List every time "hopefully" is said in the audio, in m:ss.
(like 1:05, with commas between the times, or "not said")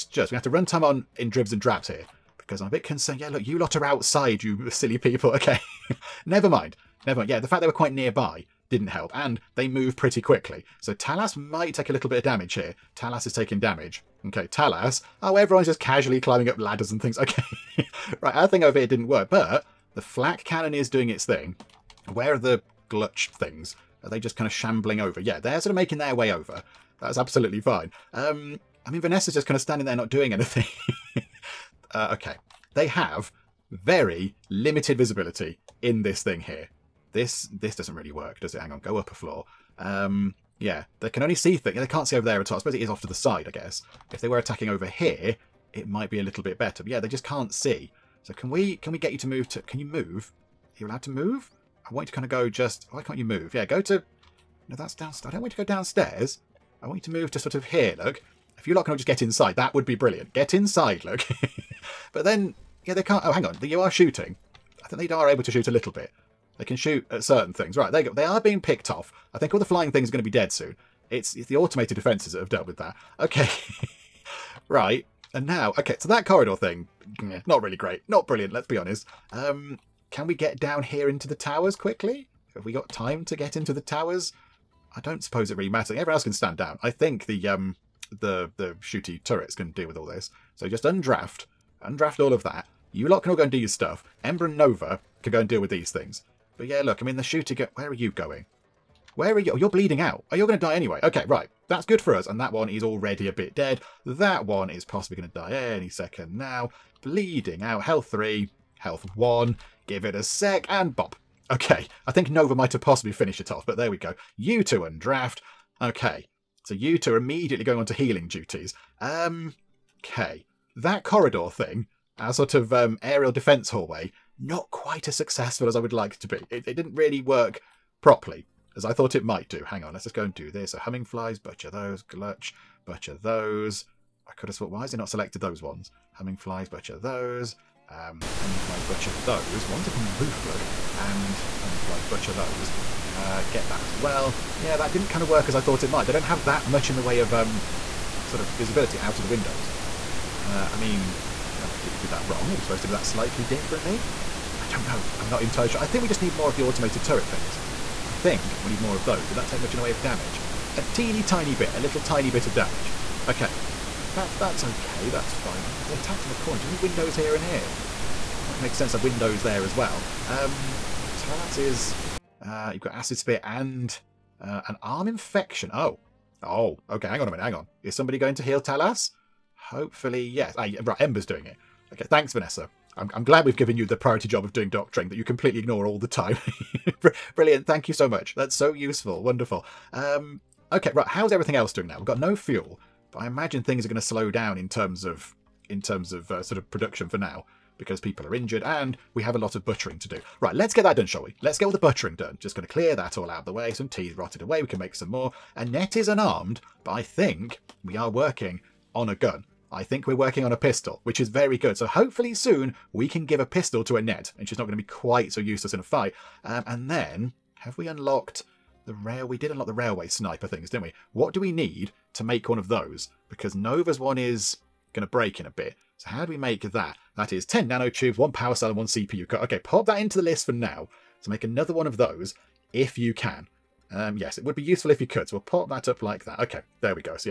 2:59, 3:31.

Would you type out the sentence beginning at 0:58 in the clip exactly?
If you lot can all just get inside, that would be brilliant.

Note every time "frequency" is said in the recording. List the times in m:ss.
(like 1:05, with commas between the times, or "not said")
not said.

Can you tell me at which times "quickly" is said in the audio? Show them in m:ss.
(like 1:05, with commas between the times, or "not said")
0:10, 1:21.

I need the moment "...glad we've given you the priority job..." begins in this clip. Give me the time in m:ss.
3:03.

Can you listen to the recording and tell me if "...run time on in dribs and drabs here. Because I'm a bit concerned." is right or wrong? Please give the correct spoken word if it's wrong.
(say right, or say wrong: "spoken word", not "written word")
right.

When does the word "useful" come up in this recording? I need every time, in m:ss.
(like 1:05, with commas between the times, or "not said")
3:08, 3:54.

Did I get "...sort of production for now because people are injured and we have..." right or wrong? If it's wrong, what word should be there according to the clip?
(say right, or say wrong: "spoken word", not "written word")
right.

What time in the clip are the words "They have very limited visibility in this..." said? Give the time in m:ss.
0:32.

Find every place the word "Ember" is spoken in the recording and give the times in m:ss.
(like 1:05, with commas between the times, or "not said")
1:34, 3:00.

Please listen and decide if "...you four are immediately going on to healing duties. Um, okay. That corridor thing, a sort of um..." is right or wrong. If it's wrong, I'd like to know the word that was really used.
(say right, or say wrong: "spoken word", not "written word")
wrong: "two", not "four".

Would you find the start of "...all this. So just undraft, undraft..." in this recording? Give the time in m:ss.
1:29.